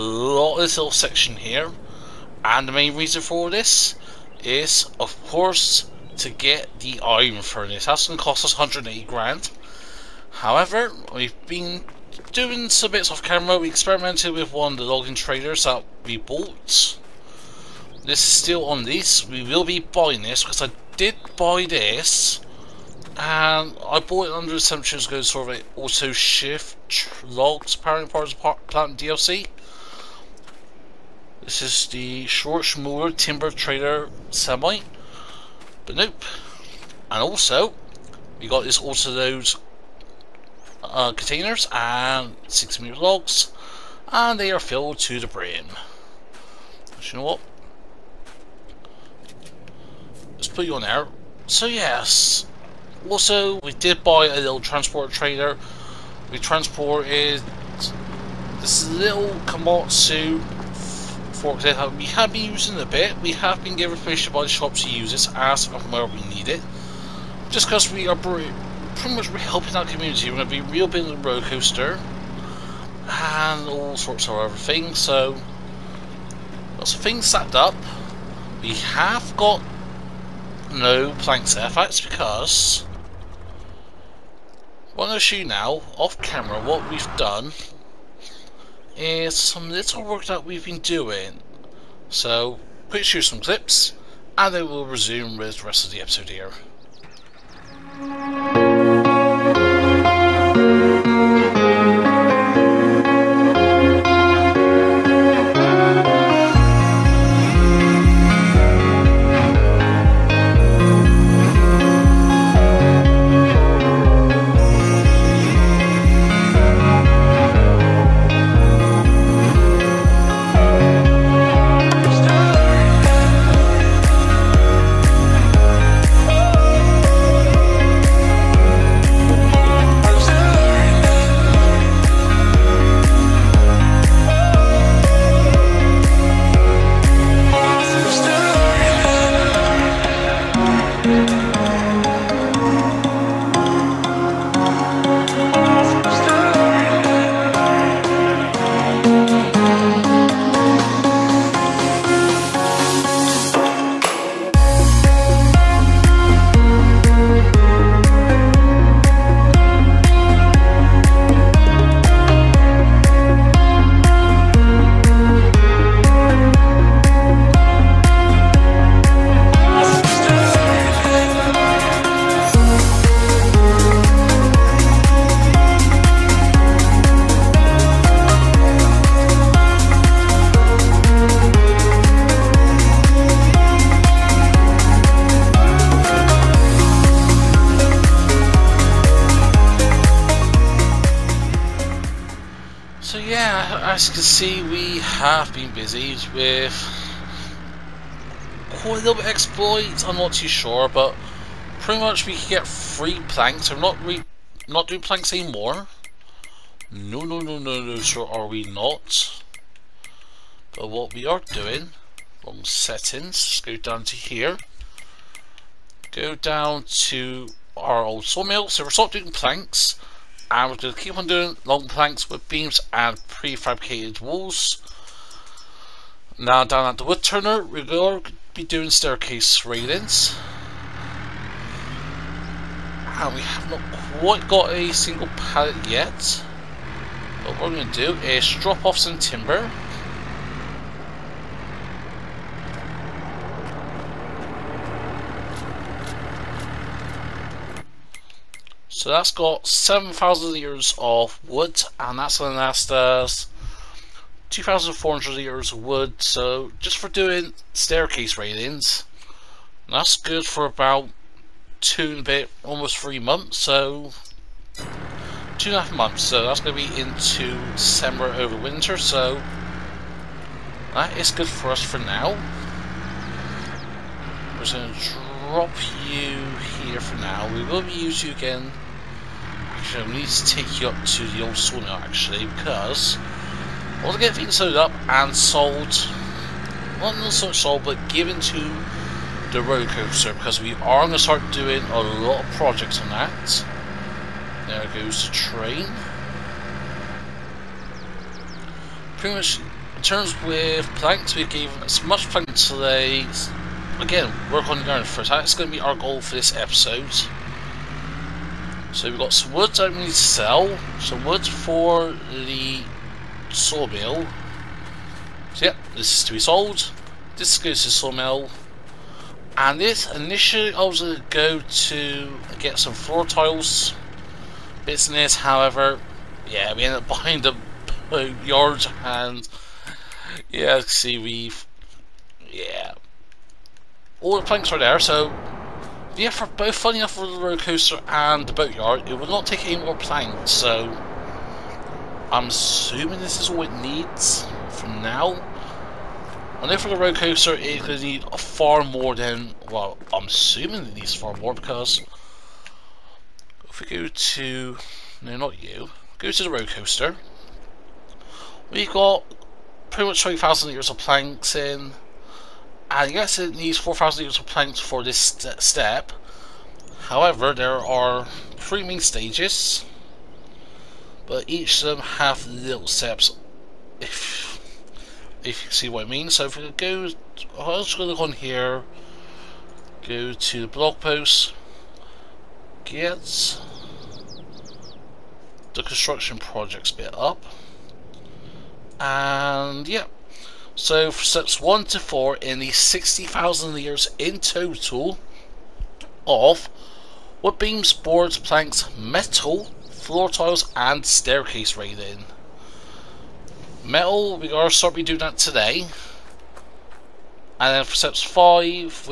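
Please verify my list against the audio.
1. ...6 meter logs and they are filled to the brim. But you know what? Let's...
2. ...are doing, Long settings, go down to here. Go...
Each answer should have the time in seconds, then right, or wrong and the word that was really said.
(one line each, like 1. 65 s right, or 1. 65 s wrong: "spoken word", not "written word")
1. 42 s right
2. 211 s right.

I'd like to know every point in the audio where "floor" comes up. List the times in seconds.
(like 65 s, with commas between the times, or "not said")
322 s, 400 s.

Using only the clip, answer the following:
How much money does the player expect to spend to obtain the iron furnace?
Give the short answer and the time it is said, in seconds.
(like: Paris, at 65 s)
180 grand, at 8 s.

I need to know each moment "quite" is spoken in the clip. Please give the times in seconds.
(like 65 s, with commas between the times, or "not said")
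198 s, 234 s.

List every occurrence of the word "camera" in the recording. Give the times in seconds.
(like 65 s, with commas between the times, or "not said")
13 s, 86 s.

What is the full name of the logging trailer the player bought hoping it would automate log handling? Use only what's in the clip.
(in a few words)
Schwarzmuller Timber Trailer Semi.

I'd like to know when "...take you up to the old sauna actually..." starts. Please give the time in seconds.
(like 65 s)
280 s.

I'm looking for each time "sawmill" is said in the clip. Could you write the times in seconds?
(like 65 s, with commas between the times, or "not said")
218 s, 313 s, 317 s.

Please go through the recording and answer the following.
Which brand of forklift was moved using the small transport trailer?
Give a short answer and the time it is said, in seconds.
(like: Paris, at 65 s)
Komatsu, at 59 s.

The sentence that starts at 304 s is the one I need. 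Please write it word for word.
Again, work on the ground first.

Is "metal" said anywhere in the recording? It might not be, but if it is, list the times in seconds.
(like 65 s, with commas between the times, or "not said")
398 s, 403 s.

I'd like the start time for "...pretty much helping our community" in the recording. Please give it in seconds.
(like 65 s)
68 s.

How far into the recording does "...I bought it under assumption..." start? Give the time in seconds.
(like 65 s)
23 s.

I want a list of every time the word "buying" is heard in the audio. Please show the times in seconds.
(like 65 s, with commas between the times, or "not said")
19 s, 327 s.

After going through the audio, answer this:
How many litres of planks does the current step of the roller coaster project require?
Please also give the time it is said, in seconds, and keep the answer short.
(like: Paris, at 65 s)
4,000 litres, at 363 s.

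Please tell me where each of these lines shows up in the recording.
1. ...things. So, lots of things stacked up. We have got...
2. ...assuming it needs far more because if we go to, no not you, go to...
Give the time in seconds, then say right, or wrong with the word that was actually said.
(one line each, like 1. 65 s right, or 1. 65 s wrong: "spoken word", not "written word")
1. 74 s right
2. 350 s right.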